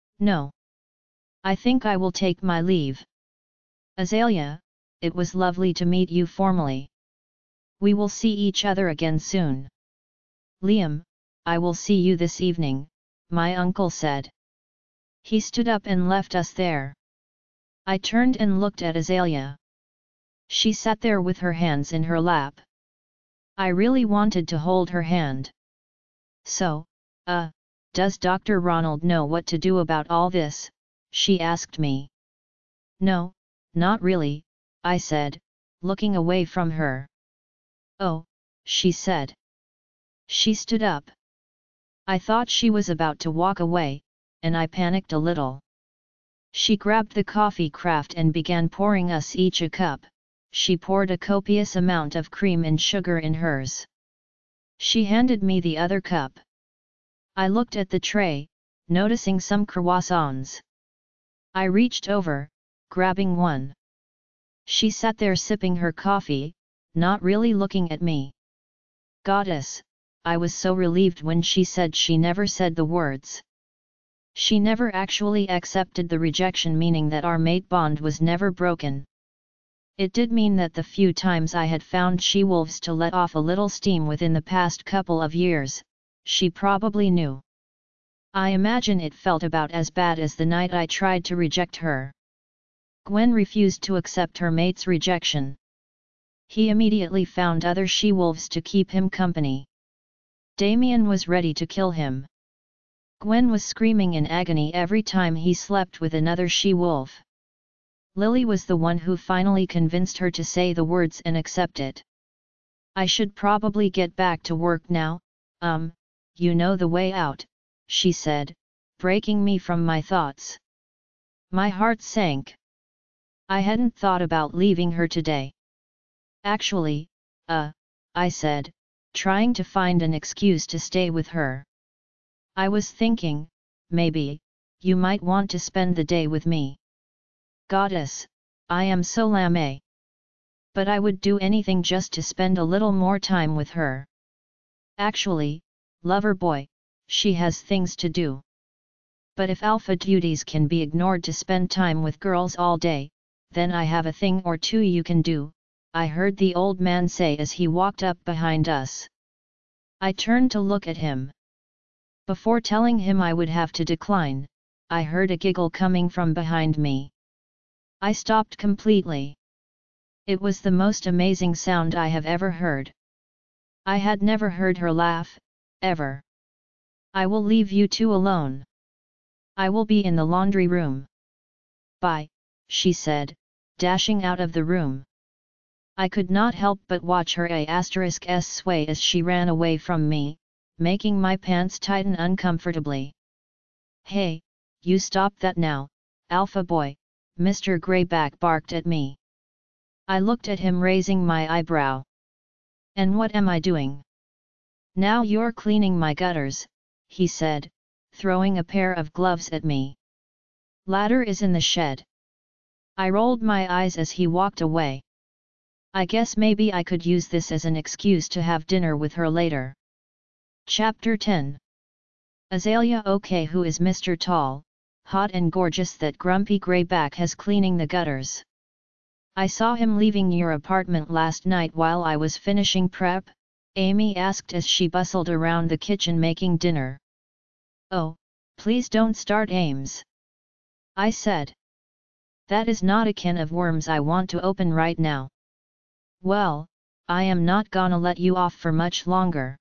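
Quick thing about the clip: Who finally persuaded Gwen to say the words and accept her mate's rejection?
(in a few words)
Lily.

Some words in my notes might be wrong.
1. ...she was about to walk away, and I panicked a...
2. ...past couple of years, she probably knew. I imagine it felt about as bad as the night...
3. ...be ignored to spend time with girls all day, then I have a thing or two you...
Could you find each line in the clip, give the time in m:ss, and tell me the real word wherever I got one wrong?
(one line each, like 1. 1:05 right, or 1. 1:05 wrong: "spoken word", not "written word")
1. 0:42 right
2. 1:24 right
3. 2:30 right.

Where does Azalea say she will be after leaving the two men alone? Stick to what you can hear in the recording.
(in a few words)
The laundry room.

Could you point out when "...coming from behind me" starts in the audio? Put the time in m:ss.
2:45.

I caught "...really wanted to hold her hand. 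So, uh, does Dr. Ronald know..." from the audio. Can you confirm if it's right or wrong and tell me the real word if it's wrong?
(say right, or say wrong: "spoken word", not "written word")
right.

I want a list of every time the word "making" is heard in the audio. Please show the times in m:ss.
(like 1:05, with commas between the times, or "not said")
3:10, 3:56.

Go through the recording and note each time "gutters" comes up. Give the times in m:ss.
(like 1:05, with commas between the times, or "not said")
3:26, 3:47.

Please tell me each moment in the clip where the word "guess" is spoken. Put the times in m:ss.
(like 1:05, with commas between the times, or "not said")
3:36.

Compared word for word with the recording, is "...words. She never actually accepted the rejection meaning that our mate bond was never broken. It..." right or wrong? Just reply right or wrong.
right.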